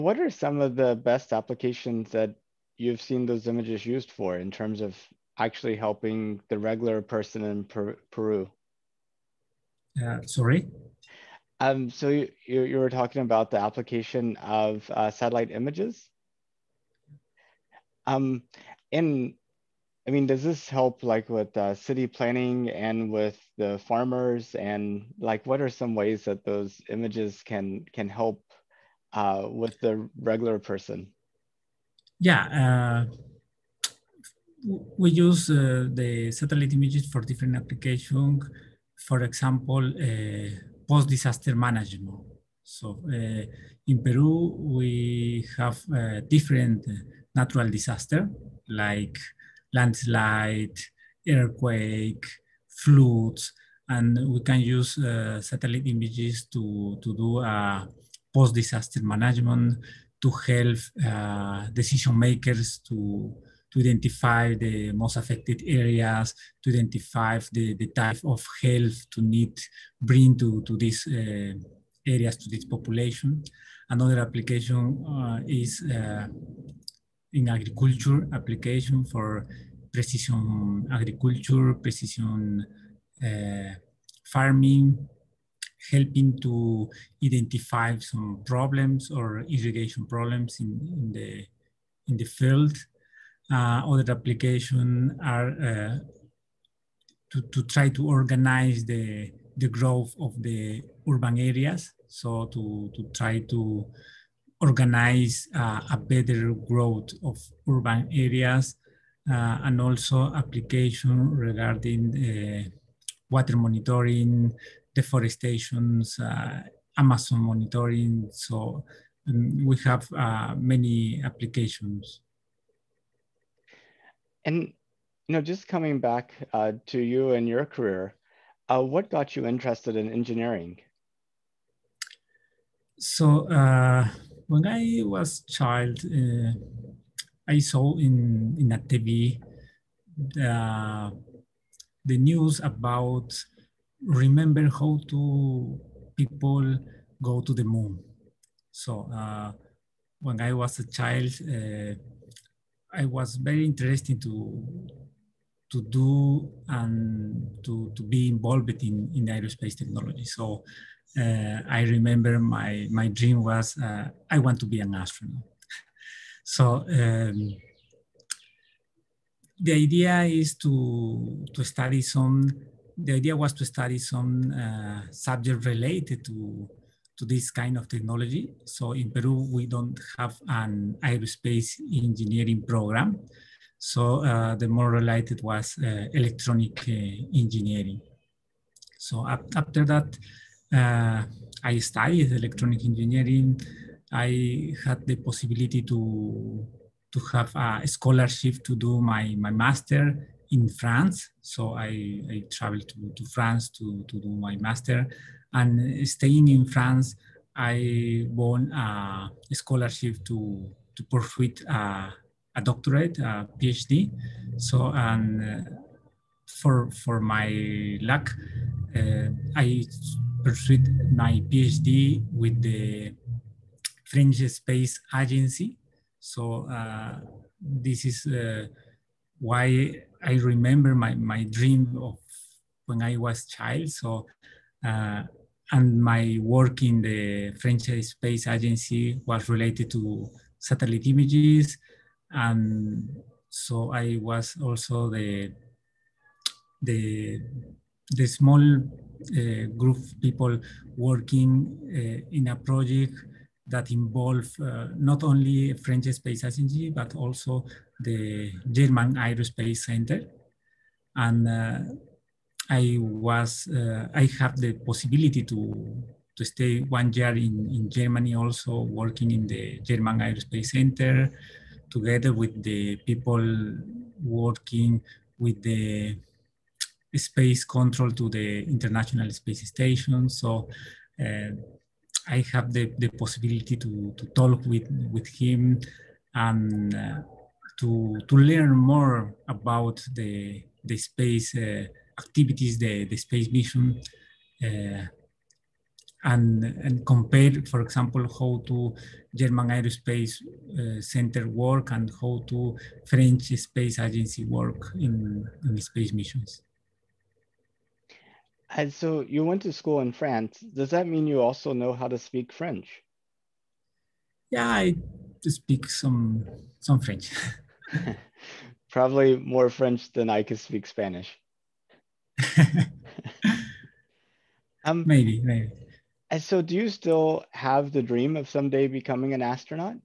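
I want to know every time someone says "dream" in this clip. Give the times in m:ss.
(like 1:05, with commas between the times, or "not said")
2:43, 3:51, 5:28.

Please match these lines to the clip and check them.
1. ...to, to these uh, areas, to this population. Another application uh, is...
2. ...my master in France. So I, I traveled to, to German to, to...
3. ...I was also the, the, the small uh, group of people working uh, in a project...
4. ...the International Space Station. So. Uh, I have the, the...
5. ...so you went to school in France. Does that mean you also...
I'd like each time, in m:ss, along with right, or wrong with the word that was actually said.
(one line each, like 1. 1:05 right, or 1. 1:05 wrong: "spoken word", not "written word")
1. 1:10 right
2. 3:19 wrong: "France", not "German"
3. 4:03 right
4. 4:38 right
5. 5:08 right.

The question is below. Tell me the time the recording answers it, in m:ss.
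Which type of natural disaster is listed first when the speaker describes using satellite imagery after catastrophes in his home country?
0:49.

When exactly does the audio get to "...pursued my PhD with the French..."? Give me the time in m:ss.
3:40.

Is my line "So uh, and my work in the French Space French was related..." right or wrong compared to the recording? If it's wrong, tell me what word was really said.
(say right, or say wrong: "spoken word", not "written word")
wrong: "Agency", not "French".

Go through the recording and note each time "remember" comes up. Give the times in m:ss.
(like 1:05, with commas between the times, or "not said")
2:24, 2:41, 3:50.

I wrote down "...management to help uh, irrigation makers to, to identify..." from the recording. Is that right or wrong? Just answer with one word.
wrong.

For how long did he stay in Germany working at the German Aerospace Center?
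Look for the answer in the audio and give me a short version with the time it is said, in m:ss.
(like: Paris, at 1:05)
1 year, at 4:26.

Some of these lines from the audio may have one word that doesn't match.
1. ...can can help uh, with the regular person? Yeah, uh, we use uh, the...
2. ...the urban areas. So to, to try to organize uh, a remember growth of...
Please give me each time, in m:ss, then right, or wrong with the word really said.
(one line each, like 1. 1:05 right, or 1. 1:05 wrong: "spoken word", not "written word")
1. 0:27 right
2. 1:40 wrong: "better", not "remember".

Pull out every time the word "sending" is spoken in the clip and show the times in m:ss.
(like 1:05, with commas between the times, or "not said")
not said.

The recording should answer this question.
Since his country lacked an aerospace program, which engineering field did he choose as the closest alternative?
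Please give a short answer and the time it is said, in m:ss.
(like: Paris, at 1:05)
Electronic engineering, at 3:06.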